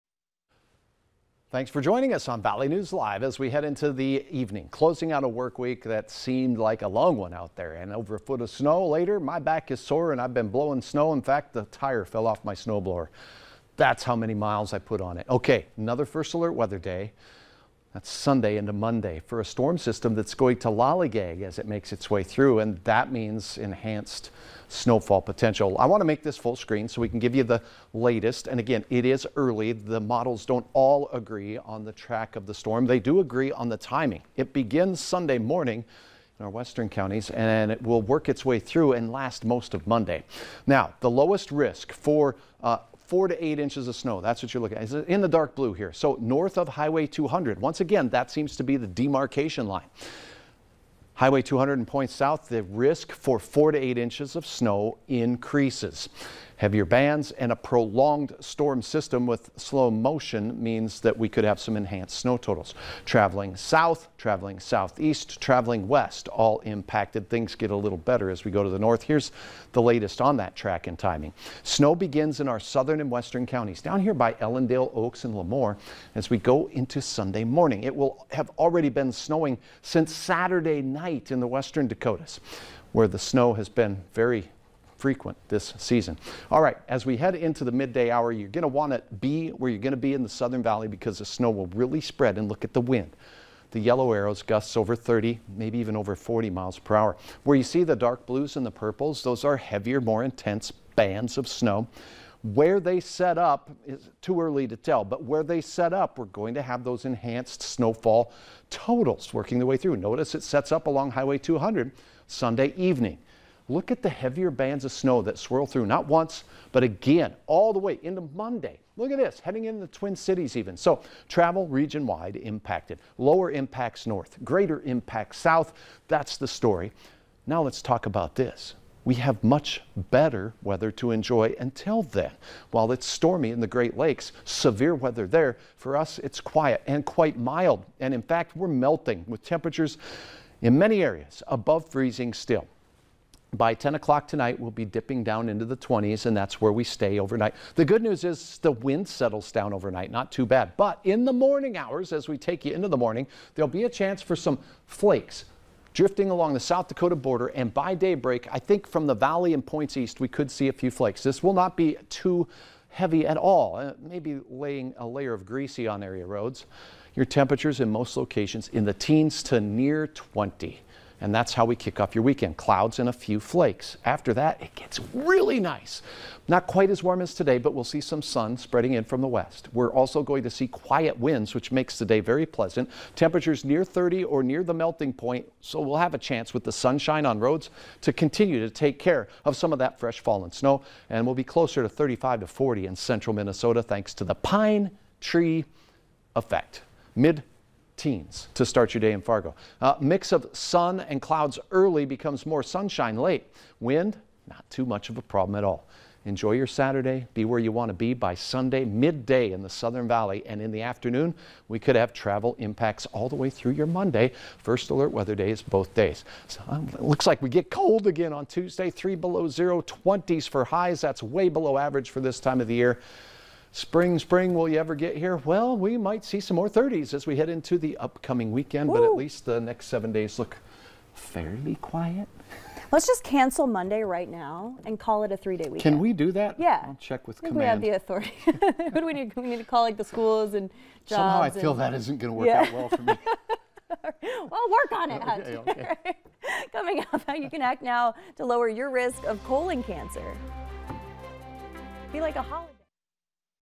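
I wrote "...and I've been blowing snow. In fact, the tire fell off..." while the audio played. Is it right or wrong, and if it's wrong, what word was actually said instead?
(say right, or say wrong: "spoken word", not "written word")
right.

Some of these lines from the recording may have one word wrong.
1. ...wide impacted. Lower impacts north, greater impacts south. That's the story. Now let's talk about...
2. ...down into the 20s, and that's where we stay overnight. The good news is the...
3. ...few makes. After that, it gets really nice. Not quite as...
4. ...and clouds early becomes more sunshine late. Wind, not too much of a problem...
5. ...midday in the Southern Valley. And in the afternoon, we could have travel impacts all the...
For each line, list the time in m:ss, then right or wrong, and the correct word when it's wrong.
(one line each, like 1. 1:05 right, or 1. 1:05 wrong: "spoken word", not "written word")
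1. 2:02 right
2. 2:25 right
3. 2:53 wrong: "flakes", not "makes"
4. 3:21 right
5. 3:28 right.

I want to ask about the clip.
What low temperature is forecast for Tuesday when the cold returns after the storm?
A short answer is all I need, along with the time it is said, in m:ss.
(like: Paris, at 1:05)
-3, at 3:38.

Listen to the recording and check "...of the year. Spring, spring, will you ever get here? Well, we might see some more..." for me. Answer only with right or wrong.
right.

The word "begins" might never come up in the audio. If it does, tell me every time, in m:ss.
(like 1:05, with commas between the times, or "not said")
0:34, 1:11.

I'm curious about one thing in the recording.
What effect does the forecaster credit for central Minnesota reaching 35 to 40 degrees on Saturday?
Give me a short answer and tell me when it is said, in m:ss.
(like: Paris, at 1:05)
pine tree effect, at 3:14.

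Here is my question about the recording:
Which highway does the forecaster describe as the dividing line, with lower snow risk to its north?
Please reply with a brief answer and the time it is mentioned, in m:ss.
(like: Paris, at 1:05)
Highway 200, at 0:46.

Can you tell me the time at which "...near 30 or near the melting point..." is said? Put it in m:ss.
3:03.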